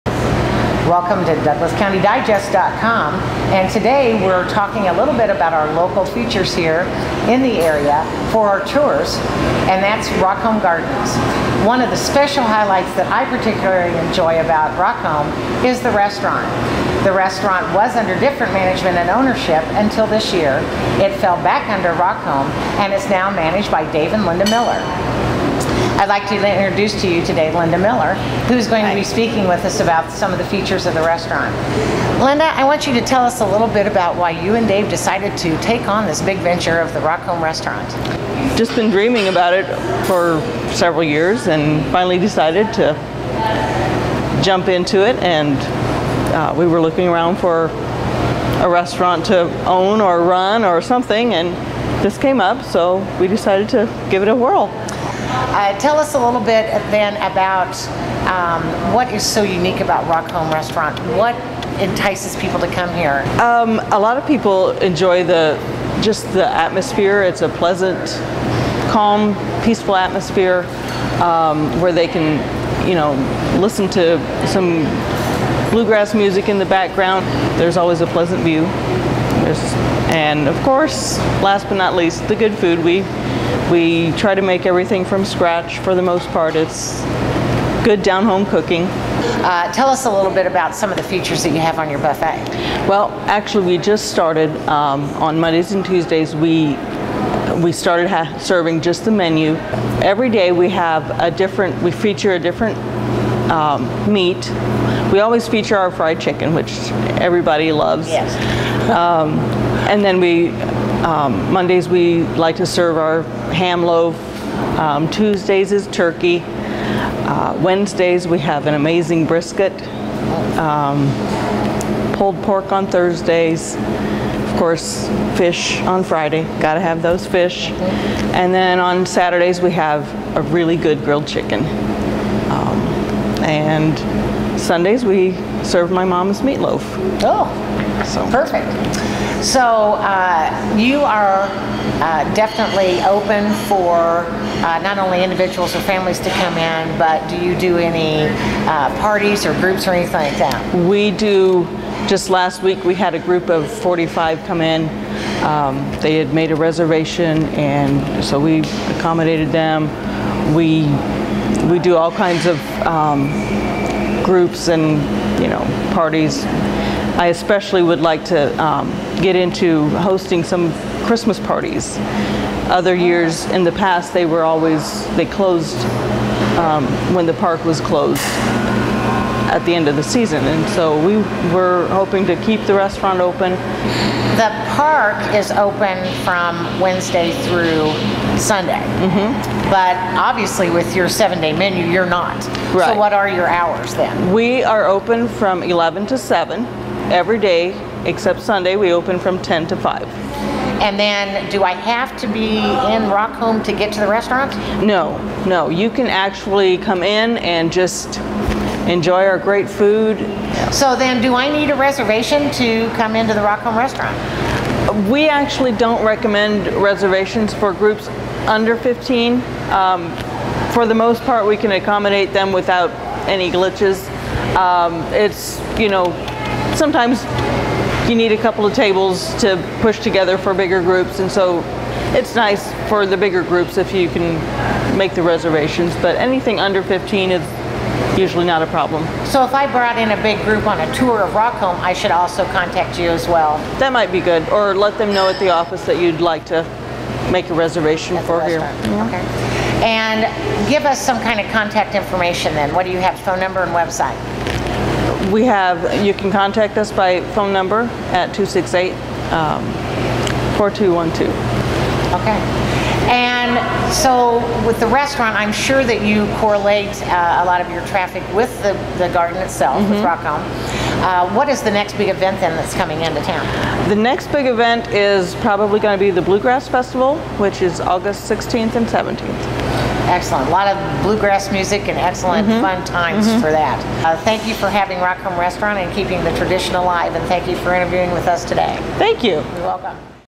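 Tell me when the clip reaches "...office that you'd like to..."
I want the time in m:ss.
4:05.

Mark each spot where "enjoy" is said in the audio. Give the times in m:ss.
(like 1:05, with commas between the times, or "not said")
0:14, 1:04, 3:28.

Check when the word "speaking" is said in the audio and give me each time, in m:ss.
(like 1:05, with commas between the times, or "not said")
0:29.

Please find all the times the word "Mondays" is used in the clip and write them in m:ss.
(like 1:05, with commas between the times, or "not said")
1:35, 1:51.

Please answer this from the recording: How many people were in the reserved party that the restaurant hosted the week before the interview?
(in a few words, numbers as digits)
45.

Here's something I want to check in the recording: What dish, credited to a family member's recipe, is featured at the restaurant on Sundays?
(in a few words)
Meatloaf.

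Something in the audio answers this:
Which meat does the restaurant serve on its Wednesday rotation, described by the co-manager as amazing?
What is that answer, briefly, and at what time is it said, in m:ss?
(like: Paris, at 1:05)
Brisket, at 1:59.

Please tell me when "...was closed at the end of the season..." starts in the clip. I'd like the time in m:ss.
2:57.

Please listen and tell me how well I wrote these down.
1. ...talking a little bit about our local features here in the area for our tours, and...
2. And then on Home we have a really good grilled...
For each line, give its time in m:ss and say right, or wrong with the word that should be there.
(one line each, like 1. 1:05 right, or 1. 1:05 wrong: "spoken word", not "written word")
1. 0:04 right
2. 2:08 wrong: "Saturdays", not "Home".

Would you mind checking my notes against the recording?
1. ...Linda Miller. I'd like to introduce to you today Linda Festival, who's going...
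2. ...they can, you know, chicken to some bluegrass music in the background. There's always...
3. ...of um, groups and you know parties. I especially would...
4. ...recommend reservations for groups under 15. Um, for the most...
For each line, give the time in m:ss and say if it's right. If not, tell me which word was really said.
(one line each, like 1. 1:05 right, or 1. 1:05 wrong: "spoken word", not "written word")
1. 0:24 wrong: "Miller", not "Festival"
2. 1:11 wrong: "listen", not "chicken"
3. 2:42 right
4. 3:36 right.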